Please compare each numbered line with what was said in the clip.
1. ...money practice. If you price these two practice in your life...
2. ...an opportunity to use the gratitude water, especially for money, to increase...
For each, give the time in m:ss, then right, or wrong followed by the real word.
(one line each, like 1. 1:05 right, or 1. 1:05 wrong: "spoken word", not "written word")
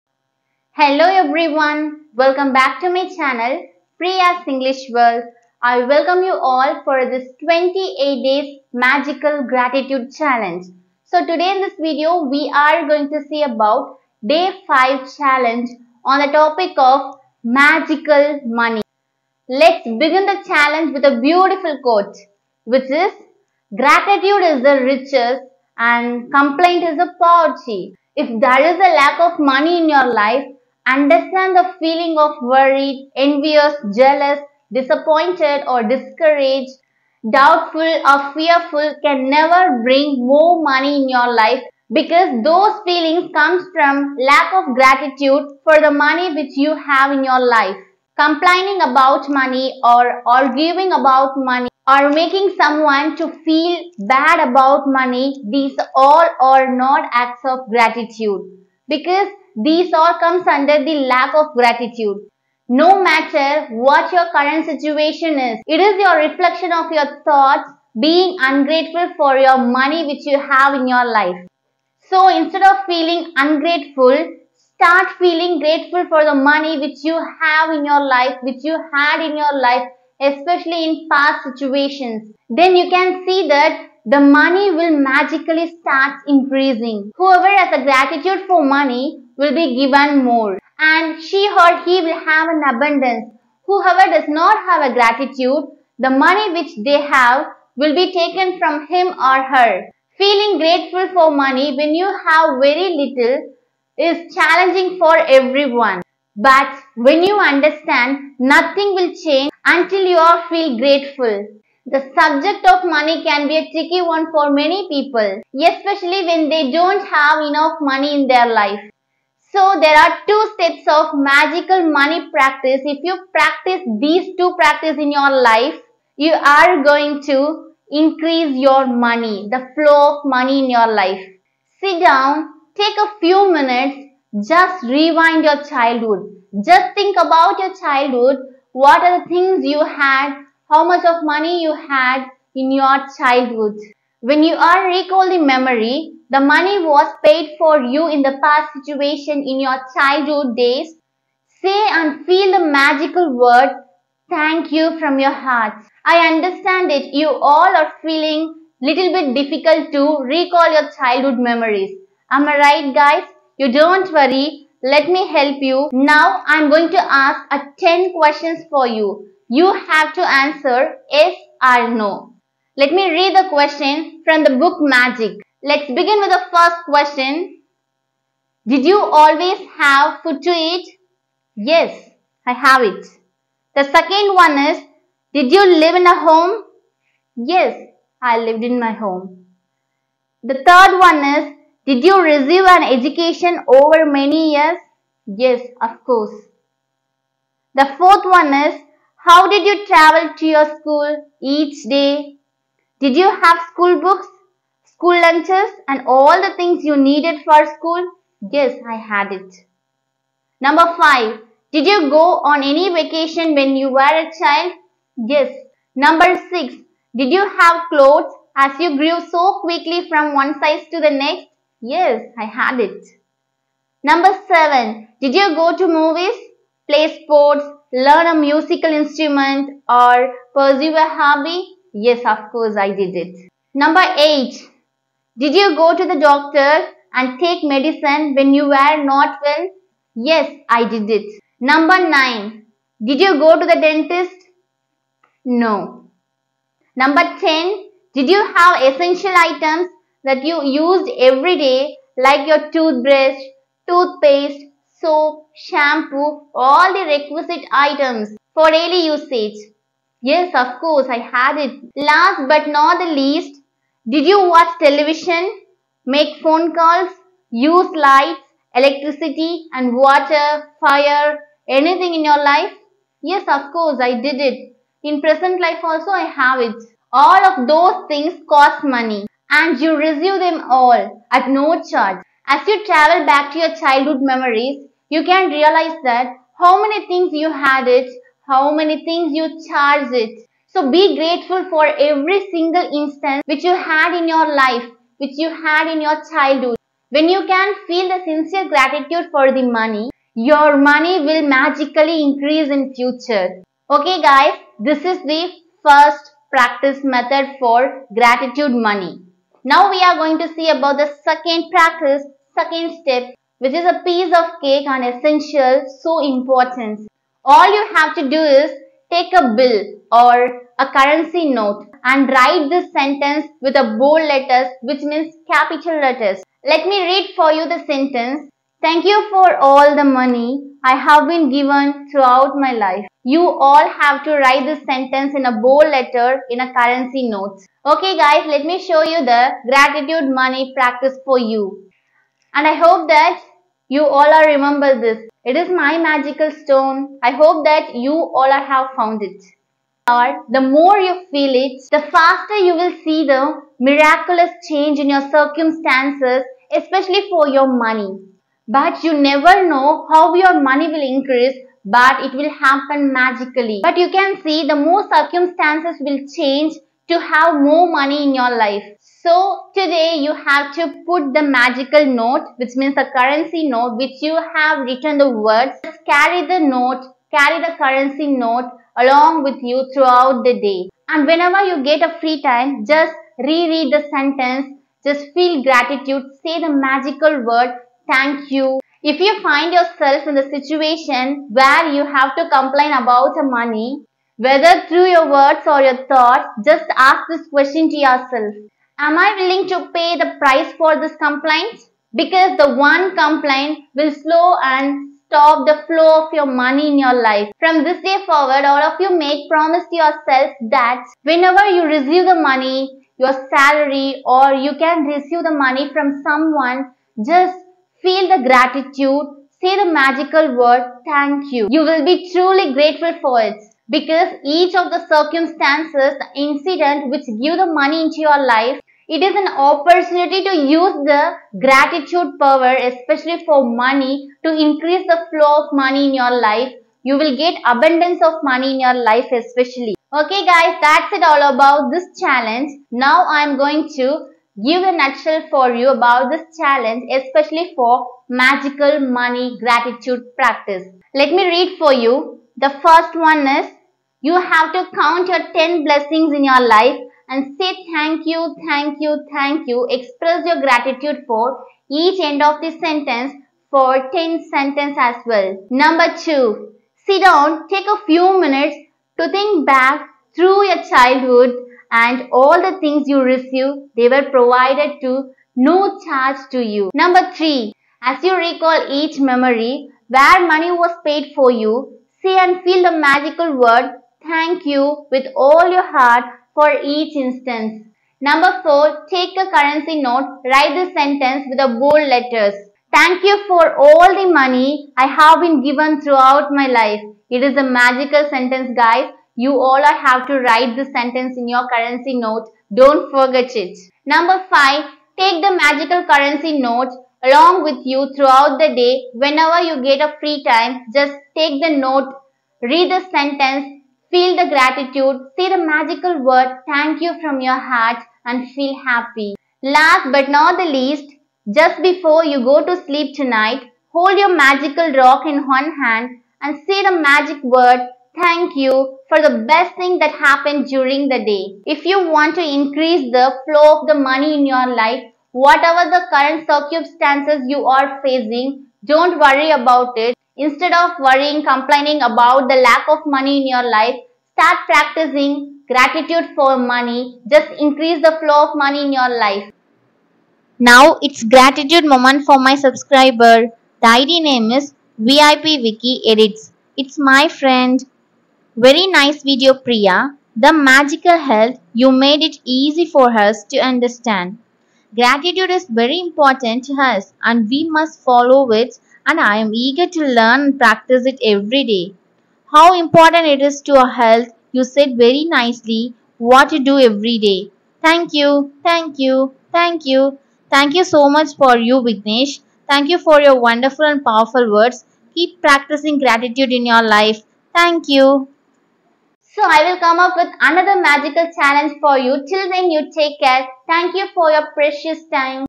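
1. 2:01 wrong: "practice", not "price"
2. 7:09 wrong: "power", not "water".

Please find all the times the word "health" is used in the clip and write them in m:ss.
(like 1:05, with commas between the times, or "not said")
9:21, 9:33.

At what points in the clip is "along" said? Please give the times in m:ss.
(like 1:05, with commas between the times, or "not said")
6:18, 8:27.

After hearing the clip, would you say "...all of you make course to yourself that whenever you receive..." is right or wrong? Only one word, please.
wrong.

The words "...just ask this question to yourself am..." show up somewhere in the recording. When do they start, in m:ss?
6:36.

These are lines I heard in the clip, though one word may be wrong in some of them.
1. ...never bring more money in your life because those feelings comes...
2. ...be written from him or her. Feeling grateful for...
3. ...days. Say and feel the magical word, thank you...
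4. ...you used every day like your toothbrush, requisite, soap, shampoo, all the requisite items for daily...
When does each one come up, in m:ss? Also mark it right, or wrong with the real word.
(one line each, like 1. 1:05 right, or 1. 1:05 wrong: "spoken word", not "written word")
1. 0:39 right
2. 1:37 wrong: "taken", not "written"
3. 2:30 right
4. 4:10 wrong: "toothpaste", not "requisite".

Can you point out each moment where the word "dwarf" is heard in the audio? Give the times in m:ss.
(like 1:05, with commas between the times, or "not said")
not said.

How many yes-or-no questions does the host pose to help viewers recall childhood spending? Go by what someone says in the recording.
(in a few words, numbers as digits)
10.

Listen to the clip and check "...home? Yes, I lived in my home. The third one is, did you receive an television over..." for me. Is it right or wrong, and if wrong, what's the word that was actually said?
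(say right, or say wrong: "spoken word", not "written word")
wrong: "education", not "television".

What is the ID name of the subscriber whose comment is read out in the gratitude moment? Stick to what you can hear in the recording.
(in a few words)
VIP Wiki Edits.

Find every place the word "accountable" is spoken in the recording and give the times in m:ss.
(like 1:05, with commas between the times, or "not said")
not said.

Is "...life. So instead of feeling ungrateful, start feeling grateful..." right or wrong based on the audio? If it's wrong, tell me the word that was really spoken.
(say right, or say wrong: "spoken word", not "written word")
right.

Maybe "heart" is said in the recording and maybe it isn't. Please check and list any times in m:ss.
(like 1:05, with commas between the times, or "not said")
2:35, 8:05, 8:37.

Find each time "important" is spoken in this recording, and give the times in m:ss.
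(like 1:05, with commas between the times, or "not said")
5:16, 9:25, 9:32.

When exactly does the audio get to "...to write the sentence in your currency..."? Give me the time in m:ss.
8:20.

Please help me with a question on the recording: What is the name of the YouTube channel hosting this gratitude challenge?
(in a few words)
Priya's English World.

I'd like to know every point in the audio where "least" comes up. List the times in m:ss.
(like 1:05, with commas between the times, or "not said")
4:23, 8:40.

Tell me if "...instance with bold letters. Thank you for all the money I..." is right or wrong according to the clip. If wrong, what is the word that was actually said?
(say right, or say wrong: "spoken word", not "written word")
wrong: "sentence", not "instance".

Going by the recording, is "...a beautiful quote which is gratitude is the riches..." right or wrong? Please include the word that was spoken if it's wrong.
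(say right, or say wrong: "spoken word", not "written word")
right.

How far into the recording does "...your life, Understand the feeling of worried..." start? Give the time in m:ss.
0:29.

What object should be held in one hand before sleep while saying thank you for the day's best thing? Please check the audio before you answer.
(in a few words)
Magical rock.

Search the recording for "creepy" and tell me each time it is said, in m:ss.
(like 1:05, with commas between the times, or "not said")
not said.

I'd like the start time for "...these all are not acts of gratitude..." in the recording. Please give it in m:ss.
0:55.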